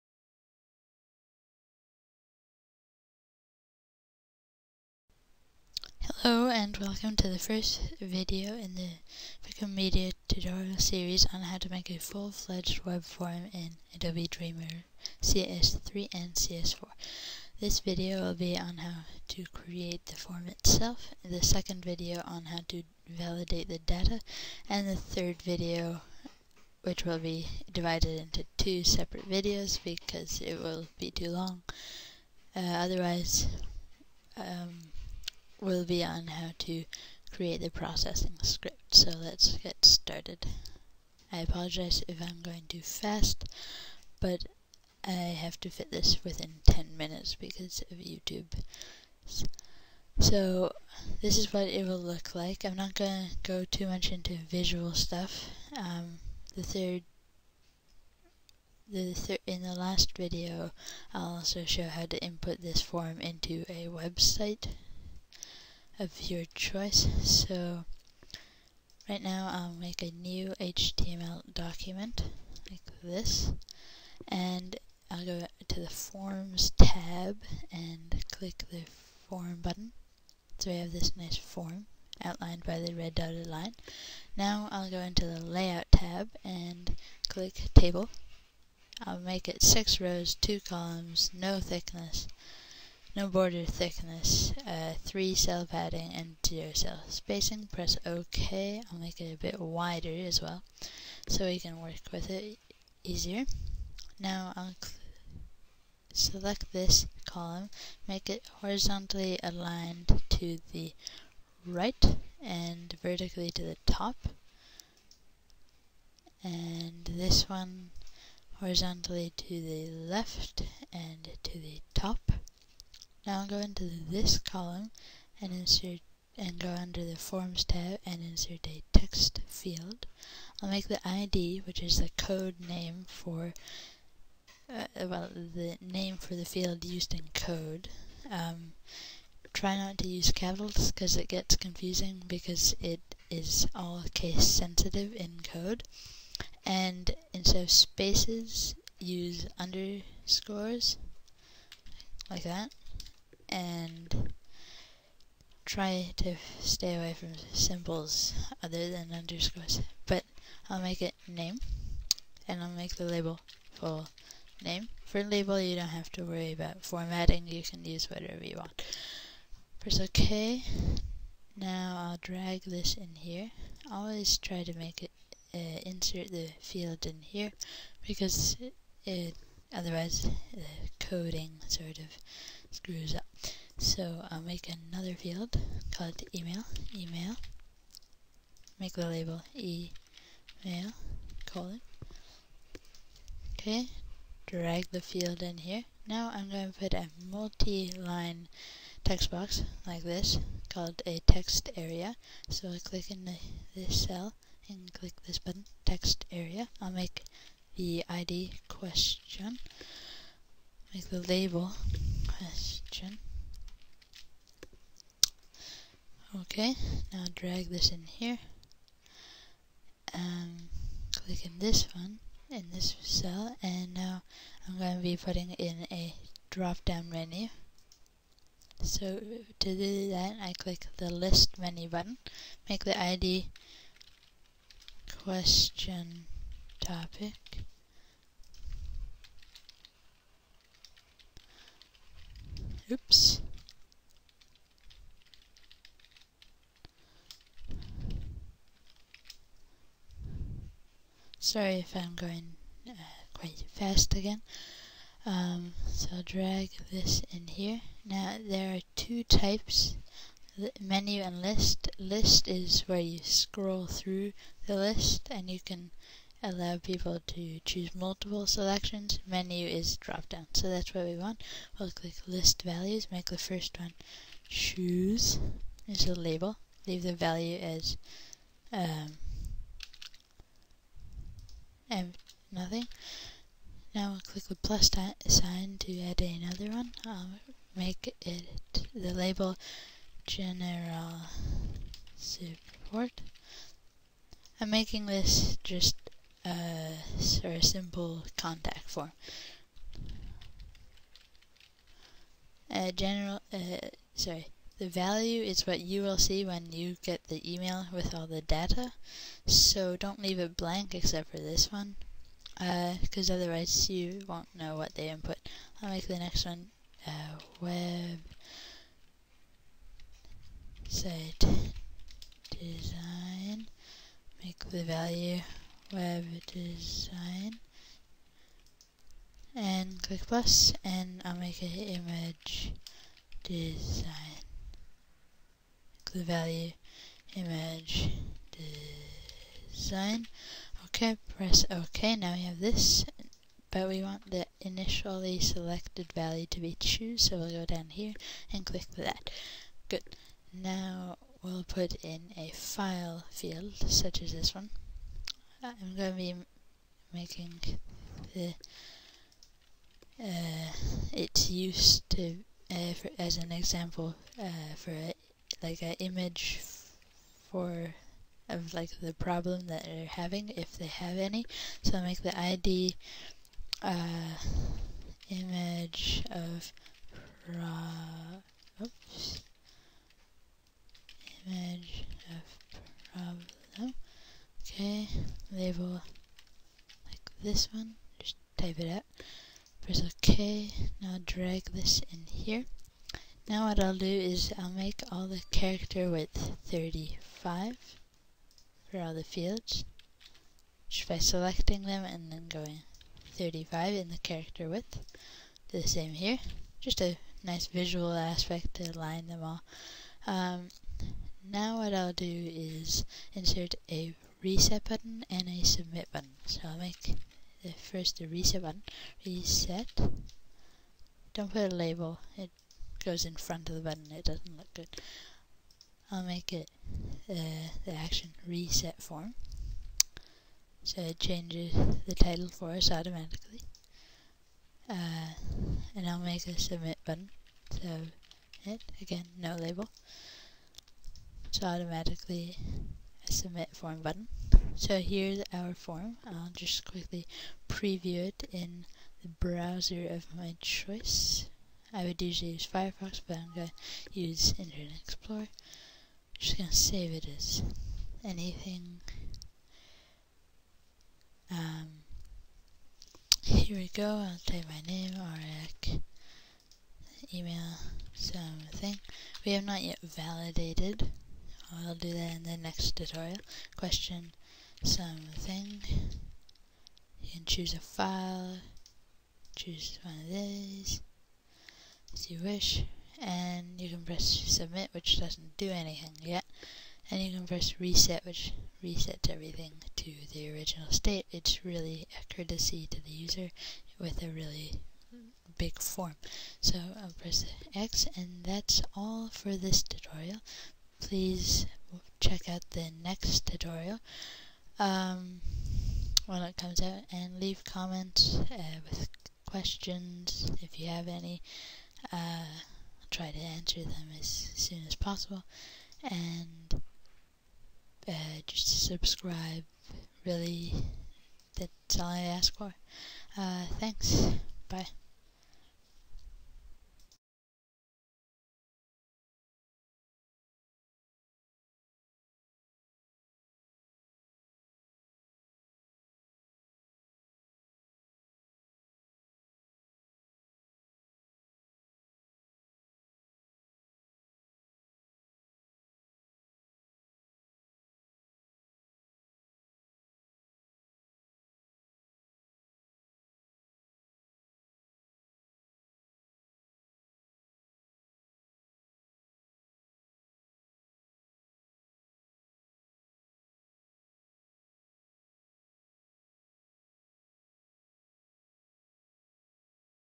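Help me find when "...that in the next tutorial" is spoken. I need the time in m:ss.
7:52.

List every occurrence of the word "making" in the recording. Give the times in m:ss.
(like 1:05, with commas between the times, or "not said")
4:54, 5:57.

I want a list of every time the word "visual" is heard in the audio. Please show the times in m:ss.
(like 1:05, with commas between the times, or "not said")
0:54, 6:47.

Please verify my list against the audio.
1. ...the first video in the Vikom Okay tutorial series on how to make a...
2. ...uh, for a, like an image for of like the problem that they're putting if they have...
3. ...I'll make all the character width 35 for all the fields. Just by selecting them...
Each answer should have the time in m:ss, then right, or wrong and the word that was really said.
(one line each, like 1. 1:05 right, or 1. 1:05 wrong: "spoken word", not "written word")
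1. 0:07 wrong: "Media", not "Okay"
2. 6:04 wrong: "having", not "putting"
3. 6:34 right.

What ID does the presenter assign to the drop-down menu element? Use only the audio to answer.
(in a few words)
question topic.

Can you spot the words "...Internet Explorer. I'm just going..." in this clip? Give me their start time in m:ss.
7:34.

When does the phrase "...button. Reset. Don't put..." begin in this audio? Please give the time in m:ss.
6:58.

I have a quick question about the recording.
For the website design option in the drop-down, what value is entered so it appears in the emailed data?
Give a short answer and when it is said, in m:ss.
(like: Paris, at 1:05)
web design, at 5:25.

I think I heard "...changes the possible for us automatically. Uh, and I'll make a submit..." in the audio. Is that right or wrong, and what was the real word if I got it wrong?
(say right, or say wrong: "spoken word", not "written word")
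wrong: "title", not "possible".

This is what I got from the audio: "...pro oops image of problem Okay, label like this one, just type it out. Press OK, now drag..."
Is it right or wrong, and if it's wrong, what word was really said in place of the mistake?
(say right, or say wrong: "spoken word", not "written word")
right.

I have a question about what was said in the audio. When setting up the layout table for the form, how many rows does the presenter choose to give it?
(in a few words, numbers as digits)
6.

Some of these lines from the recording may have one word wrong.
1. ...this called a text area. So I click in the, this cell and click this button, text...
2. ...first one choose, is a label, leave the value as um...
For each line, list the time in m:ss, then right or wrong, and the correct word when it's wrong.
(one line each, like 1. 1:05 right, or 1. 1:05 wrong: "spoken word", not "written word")
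1. 3:20 right
2. 4:33 right.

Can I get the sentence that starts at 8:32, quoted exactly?
Uh, I'll try to answer them as soon as possible and uh, just subscribe.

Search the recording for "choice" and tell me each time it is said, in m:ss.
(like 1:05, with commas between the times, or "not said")
1:06, 7:30.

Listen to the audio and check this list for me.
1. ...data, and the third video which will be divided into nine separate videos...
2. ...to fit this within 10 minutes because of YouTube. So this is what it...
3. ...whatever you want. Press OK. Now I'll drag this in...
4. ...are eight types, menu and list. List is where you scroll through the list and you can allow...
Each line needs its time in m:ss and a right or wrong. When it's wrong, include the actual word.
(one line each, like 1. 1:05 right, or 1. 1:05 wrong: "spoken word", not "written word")
1. 0:23 wrong: "two", not "nine"
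2. 0:45 right
3. 2:48 right
4. 4:18 wrong: "two", not "eight".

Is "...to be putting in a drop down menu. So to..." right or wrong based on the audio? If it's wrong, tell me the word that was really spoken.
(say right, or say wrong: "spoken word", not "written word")
right.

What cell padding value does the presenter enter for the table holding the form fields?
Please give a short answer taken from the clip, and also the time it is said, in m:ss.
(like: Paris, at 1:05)
3, at 1:35.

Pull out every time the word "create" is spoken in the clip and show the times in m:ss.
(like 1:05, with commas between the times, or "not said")
0:19, 0:37.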